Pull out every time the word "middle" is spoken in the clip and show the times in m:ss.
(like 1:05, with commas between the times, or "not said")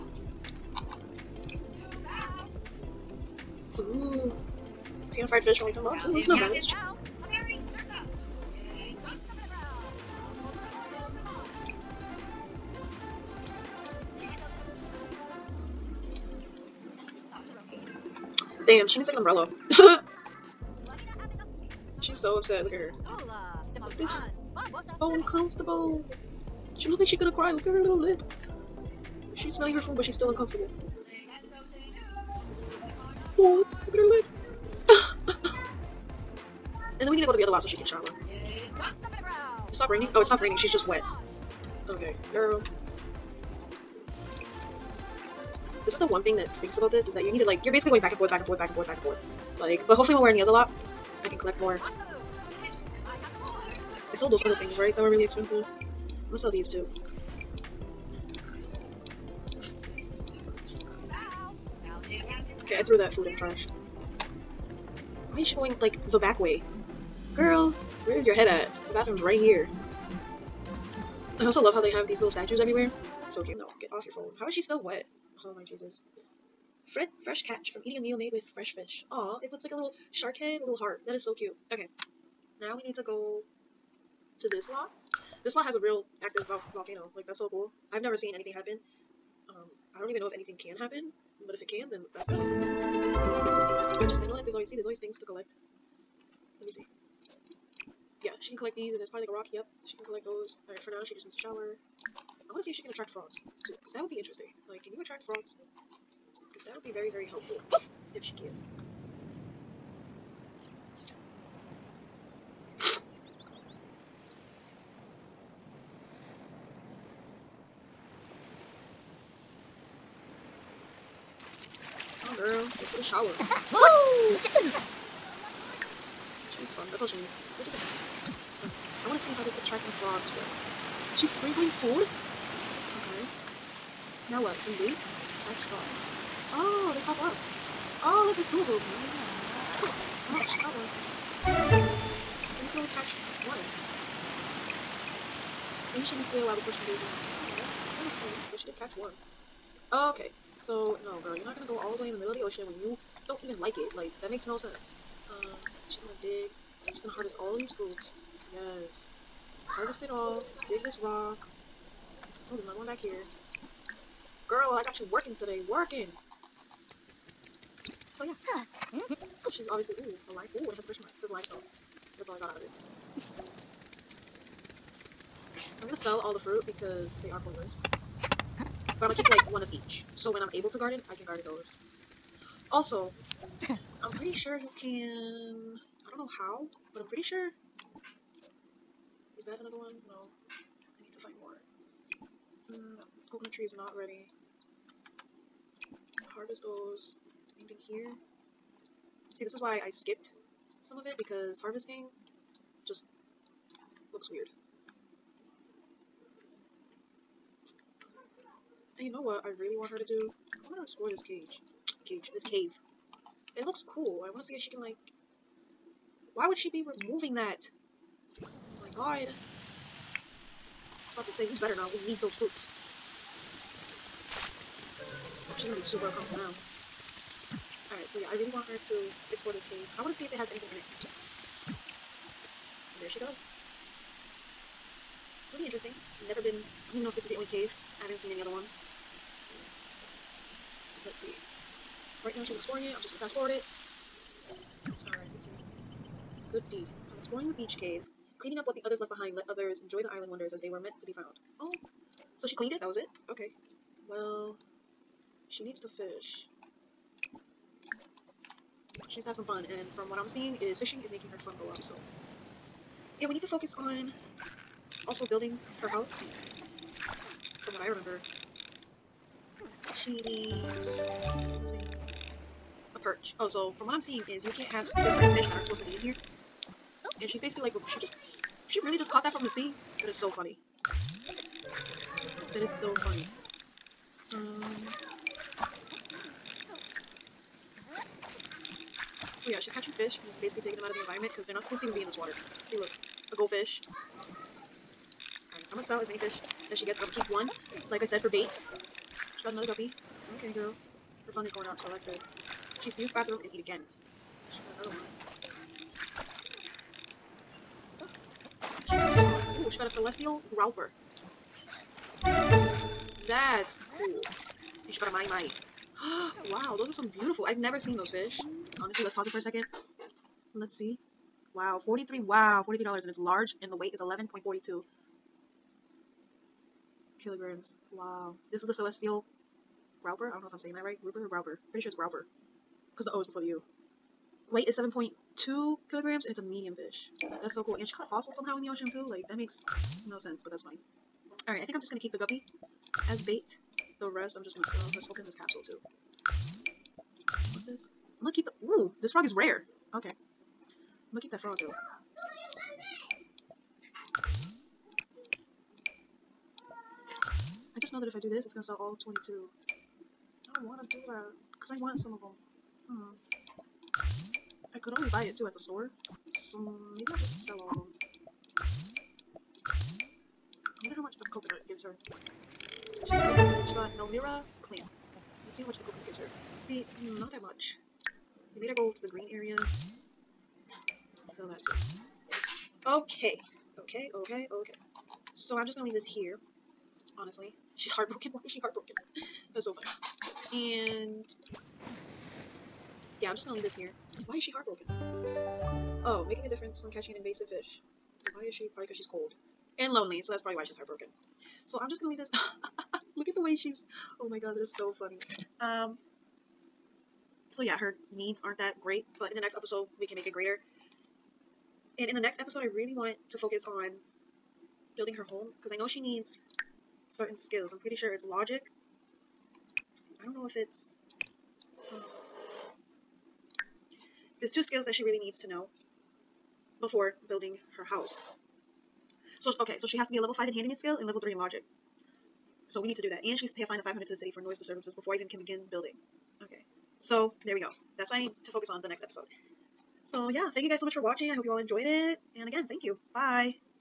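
2:32.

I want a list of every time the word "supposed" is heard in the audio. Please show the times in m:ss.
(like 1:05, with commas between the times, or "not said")
4:35, 4:51.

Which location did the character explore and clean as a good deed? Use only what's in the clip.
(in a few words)
The beach cave.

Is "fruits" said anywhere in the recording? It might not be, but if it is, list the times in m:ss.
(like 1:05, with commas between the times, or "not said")
2:37, 2:56.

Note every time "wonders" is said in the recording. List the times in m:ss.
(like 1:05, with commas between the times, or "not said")
4:10, 6:10.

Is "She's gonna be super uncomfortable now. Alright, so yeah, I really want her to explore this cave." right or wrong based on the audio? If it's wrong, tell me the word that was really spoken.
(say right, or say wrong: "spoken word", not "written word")
right.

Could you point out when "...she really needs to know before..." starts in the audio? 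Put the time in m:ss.
7:04.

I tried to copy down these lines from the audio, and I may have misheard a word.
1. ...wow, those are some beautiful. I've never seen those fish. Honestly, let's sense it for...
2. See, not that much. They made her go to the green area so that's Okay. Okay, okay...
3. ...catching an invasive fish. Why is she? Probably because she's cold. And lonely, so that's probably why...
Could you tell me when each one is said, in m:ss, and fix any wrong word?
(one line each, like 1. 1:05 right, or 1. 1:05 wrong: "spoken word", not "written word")
1. 5:16 wrong: "pause", not "sense"
2. 6:16 right
3. 6:36 right.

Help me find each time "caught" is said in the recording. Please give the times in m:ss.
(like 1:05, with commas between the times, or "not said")
4:39, 5:37.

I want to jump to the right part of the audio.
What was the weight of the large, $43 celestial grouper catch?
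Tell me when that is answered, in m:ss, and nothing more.
5:24.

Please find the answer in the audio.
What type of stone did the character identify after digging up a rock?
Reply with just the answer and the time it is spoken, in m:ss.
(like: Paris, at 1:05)
Limestone, at 2:51.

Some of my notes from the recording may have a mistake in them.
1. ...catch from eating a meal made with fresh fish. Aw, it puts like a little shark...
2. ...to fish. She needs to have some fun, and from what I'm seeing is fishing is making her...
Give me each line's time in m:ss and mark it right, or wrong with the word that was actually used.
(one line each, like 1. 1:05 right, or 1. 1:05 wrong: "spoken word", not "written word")
1. 1:17 right
2. 4:15 right.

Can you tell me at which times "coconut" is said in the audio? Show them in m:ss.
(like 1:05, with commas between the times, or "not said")
3:13, 6:11, 6:15.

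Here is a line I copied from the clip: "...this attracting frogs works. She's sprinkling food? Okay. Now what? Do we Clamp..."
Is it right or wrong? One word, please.
wrong.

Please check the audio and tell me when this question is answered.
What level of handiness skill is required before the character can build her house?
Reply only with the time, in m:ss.
7:10.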